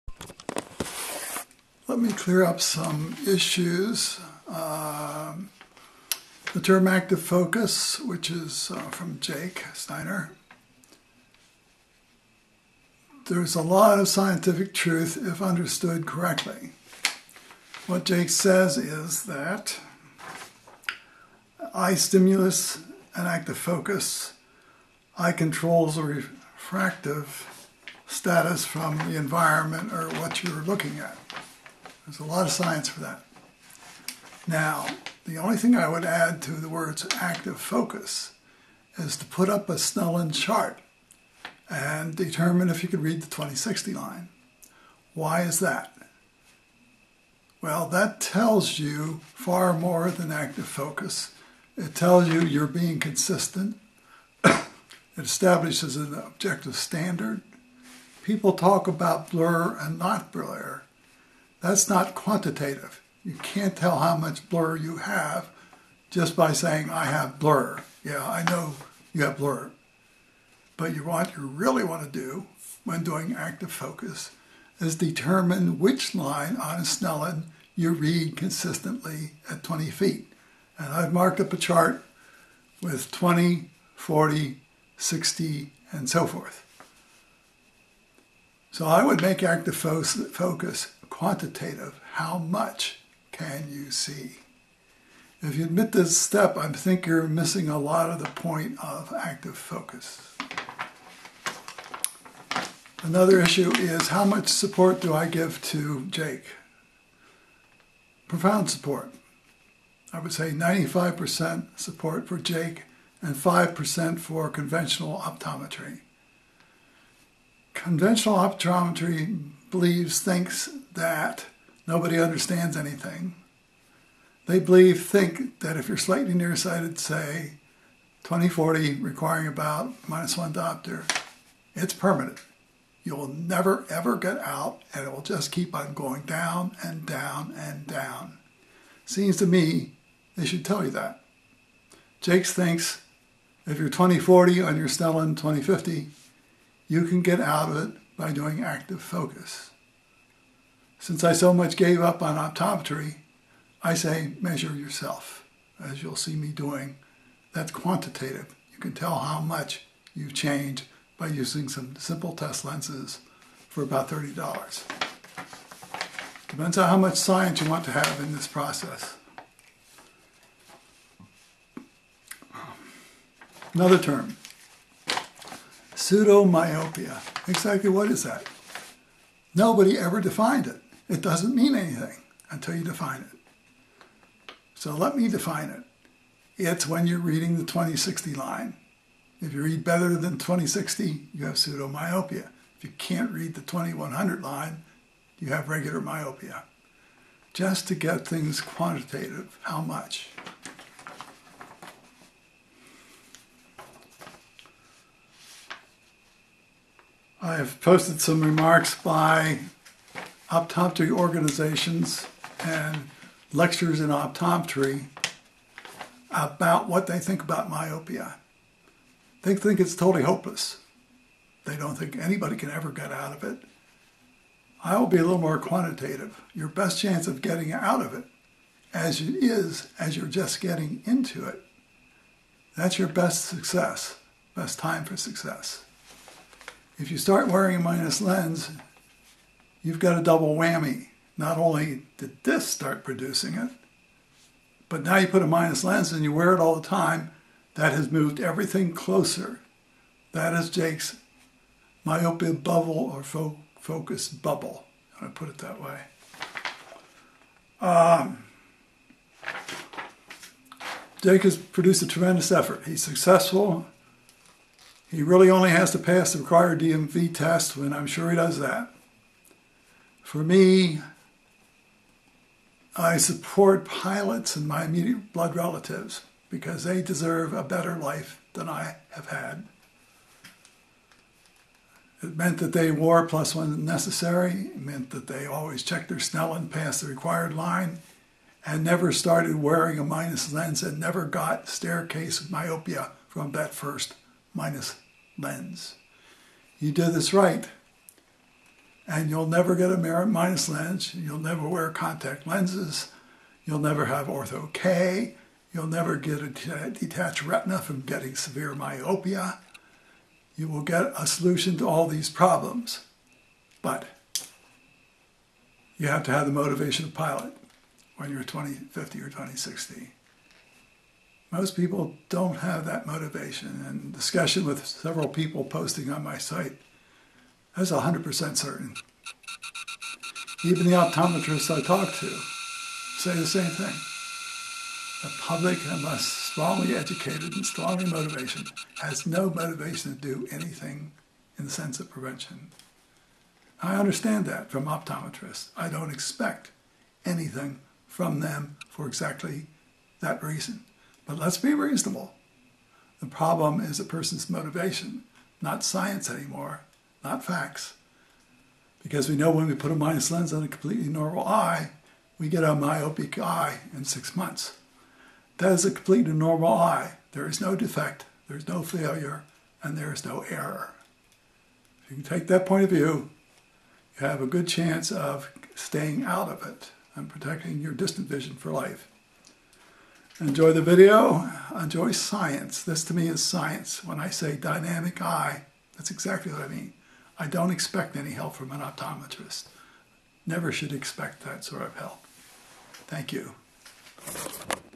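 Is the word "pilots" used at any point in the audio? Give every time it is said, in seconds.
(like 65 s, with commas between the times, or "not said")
273 s, 317 s.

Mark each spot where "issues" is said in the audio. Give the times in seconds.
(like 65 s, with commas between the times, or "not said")
3 s, 103 s.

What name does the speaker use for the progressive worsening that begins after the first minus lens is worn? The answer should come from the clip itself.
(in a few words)
staircase myopia.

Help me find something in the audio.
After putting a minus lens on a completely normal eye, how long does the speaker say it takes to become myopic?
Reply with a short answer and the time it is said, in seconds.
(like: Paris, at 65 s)
six months, at 364 s.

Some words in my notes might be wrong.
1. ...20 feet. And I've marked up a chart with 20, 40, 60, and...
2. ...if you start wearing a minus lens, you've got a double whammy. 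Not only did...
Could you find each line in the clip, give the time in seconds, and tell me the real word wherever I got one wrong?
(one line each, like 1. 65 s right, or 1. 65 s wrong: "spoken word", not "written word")
1. 79 s right
2. 237 s right.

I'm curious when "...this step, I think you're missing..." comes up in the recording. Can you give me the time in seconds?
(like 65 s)
95 s.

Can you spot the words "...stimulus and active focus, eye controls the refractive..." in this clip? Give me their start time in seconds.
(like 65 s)
21 s.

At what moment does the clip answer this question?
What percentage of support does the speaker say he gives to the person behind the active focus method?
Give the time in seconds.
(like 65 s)
110 s.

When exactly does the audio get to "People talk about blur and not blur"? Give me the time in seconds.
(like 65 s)
58 s.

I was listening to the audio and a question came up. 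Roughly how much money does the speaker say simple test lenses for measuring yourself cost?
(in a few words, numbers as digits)
$30.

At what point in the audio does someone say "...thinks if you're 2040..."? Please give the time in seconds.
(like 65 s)
142 s.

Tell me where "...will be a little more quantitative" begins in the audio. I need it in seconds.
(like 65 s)
224 s.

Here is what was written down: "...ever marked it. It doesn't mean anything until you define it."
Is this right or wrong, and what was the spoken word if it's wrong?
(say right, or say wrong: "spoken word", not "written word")
wrong: "defined", not "marked".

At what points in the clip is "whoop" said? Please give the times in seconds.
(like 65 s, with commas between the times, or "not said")
not said.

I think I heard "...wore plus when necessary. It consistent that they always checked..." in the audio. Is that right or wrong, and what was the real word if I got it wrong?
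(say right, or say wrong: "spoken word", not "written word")
wrong: "meant", not "consistent".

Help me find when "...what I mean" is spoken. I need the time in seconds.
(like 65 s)
386 s.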